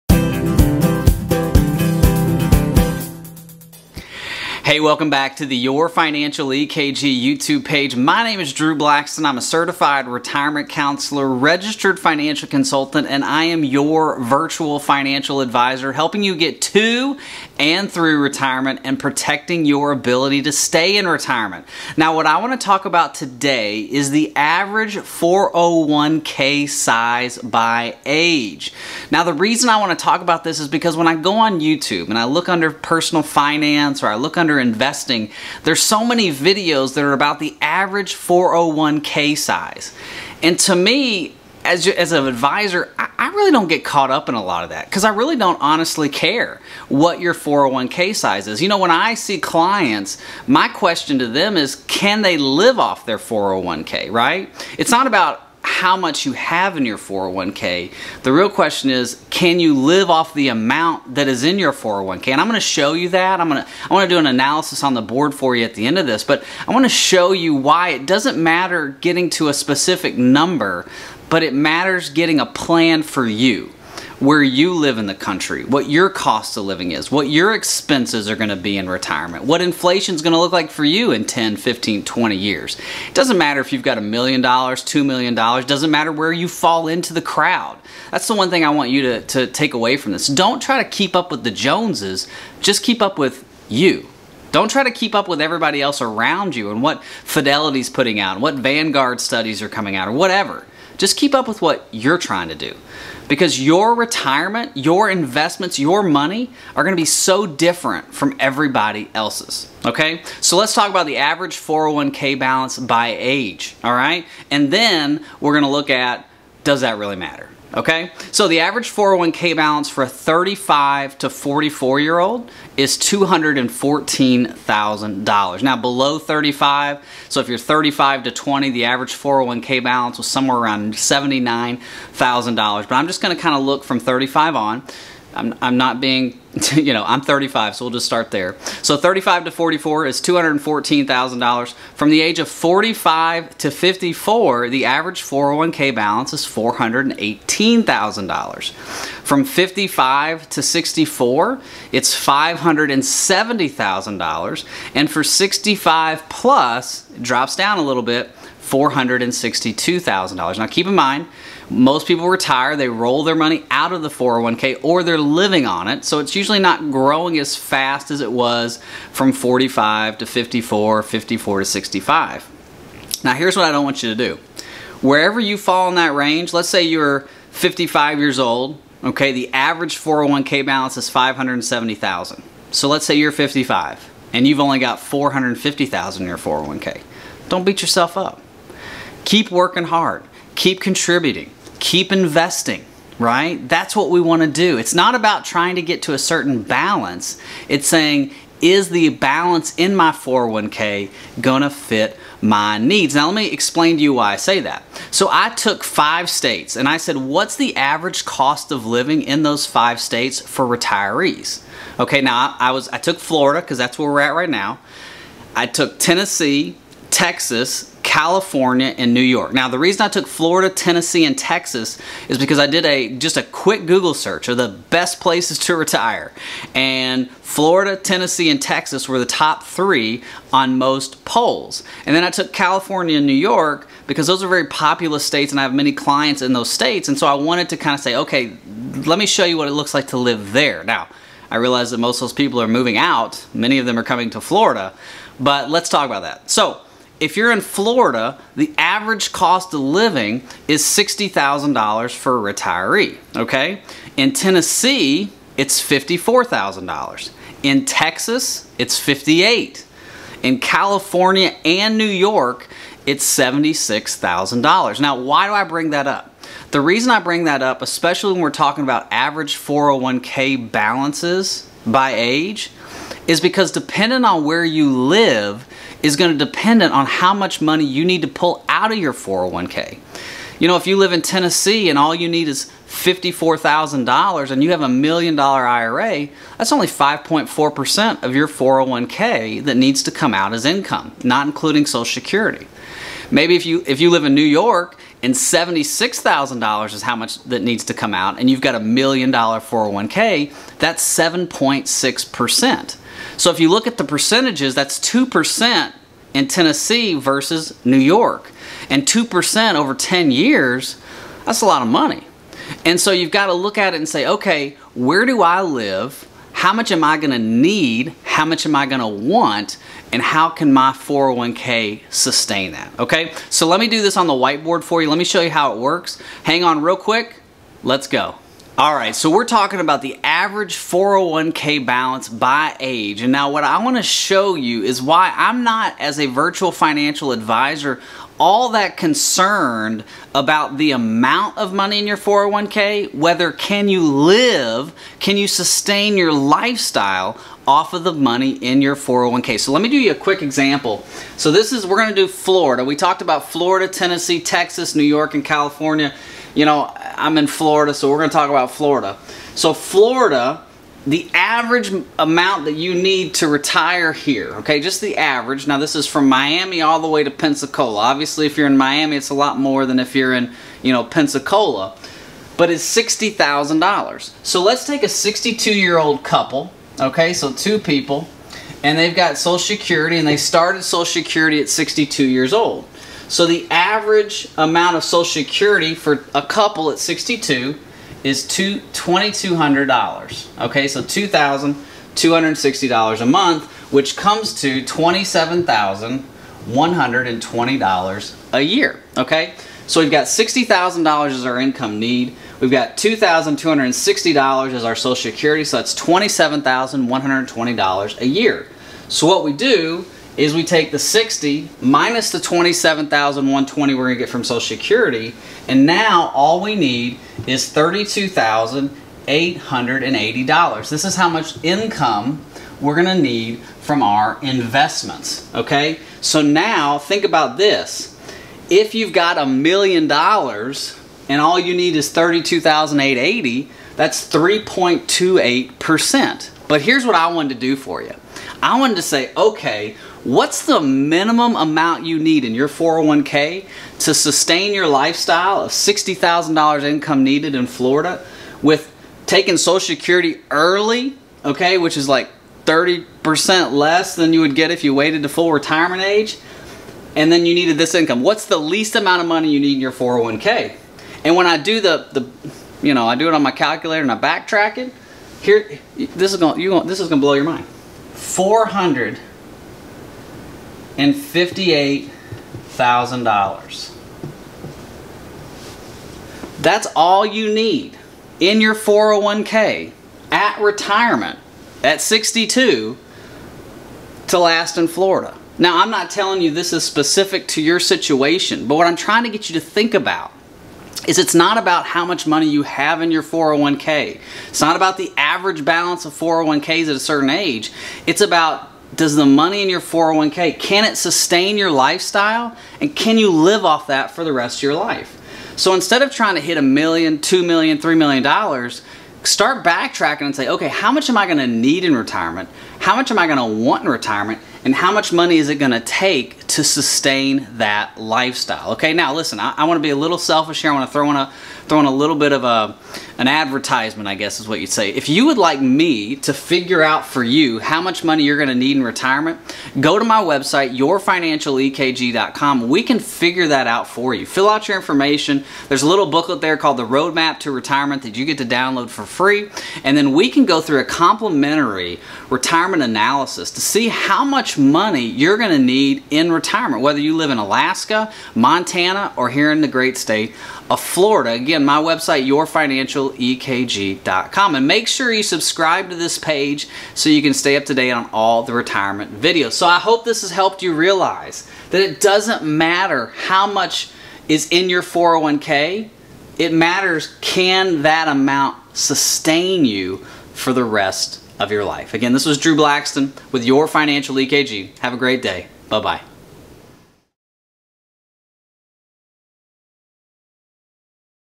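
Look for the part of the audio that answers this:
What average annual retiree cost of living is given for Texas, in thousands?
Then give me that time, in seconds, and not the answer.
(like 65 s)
258 s.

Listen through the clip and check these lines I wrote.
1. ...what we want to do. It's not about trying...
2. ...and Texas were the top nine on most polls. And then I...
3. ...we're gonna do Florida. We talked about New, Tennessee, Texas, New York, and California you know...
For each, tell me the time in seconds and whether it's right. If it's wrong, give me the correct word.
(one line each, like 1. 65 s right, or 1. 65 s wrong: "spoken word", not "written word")
1. 193 s right
2. 228 s wrong: "three", not "nine"
3. 351 s wrong: "Florida", not "New".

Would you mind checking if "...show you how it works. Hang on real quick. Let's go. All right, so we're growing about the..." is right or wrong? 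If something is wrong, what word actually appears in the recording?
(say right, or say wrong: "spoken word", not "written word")
wrong: "talking", not "growing".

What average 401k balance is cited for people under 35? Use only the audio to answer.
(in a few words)
$79,000.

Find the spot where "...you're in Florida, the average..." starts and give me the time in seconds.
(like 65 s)
247 s.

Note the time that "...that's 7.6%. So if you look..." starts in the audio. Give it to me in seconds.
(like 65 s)
300 s.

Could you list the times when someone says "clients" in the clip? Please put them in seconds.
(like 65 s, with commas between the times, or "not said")
49 s, 235 s.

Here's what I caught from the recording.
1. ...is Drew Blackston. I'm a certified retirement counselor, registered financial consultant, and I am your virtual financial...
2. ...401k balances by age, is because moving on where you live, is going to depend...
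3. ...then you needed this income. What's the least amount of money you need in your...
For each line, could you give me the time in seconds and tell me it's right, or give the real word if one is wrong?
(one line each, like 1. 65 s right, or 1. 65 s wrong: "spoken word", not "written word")
1. 8 s right
2. 269 s wrong: "depending", not "moving"
3. 457 s right.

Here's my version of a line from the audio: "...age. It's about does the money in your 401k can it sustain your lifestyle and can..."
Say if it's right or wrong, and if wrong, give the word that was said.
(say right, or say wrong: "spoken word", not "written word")
right.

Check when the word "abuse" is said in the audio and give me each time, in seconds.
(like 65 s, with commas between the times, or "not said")
not said.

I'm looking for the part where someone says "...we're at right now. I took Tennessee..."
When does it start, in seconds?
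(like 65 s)
214 s.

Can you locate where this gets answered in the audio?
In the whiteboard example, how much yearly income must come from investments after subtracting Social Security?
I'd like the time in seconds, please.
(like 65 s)
417 s.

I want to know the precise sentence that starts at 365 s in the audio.
Now this is from Miami all the way to Pensacola.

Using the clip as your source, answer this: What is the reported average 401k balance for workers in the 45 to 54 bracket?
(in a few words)
$418,000.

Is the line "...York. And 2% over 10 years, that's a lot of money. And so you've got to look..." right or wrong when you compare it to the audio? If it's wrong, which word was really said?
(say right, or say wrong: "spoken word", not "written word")
right.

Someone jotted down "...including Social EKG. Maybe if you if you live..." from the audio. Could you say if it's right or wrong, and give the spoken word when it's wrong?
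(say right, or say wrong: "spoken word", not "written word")
wrong: "Security", not "EKG".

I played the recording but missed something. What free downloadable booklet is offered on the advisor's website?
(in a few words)
The Roadmap to Retirement.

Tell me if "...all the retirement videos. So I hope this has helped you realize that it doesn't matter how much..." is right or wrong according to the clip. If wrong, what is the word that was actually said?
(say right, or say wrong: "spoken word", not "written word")
right.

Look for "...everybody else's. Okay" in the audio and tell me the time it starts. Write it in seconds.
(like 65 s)
108 s.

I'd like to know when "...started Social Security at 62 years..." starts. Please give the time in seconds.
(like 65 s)
380 s.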